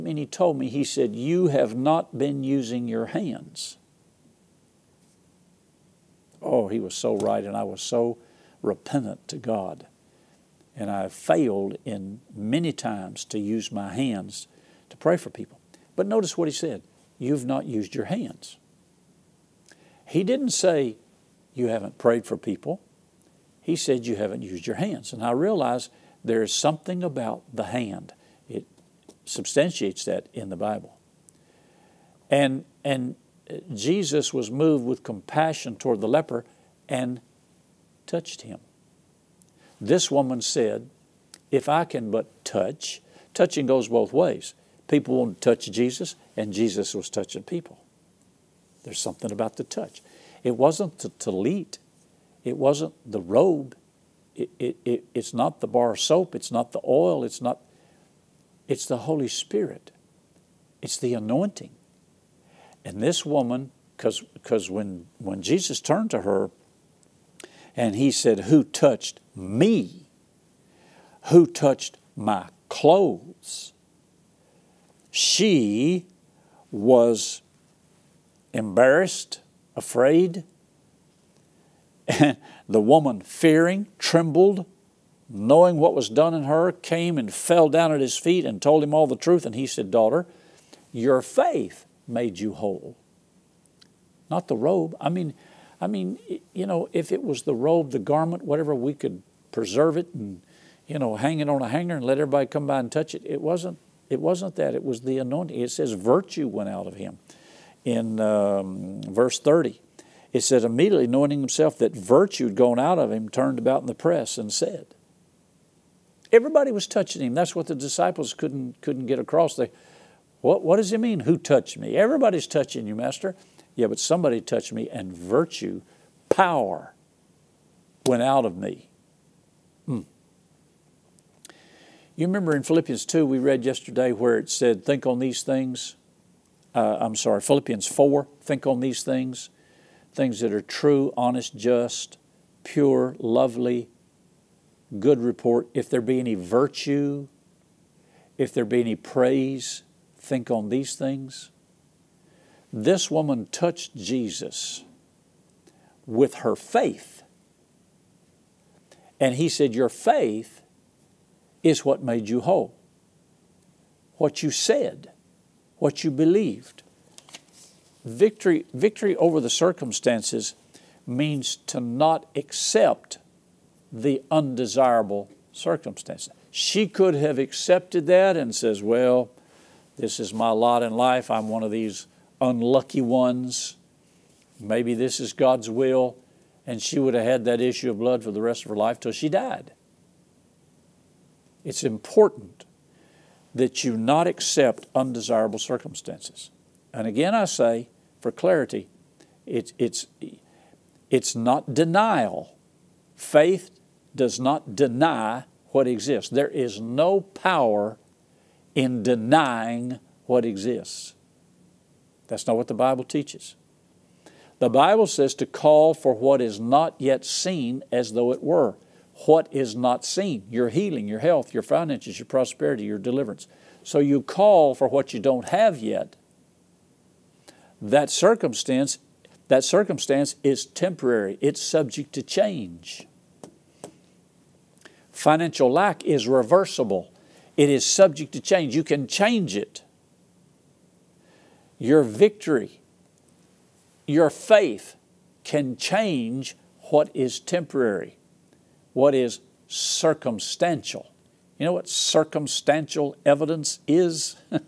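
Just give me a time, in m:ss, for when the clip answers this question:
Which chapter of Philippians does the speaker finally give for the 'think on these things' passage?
2:17.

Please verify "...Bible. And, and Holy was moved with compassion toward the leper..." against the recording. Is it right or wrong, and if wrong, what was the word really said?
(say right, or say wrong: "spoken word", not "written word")
wrong: "Jesus", not "Holy".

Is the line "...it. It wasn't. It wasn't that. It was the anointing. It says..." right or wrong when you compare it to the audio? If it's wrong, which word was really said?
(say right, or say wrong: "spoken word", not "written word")
right.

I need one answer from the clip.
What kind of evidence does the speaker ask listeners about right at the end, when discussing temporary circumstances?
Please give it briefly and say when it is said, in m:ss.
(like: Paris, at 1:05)
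circumstantial evidence, at 4:11.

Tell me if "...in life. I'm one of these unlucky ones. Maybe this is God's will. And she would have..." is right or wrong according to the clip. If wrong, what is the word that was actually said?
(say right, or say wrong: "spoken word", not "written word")
right.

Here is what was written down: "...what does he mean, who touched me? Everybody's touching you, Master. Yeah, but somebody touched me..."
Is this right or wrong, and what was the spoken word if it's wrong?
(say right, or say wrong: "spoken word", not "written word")
right.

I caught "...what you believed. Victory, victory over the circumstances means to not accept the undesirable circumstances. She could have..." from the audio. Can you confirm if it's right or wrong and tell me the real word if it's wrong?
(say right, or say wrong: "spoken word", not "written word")
right.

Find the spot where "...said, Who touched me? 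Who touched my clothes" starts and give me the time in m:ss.
1:08.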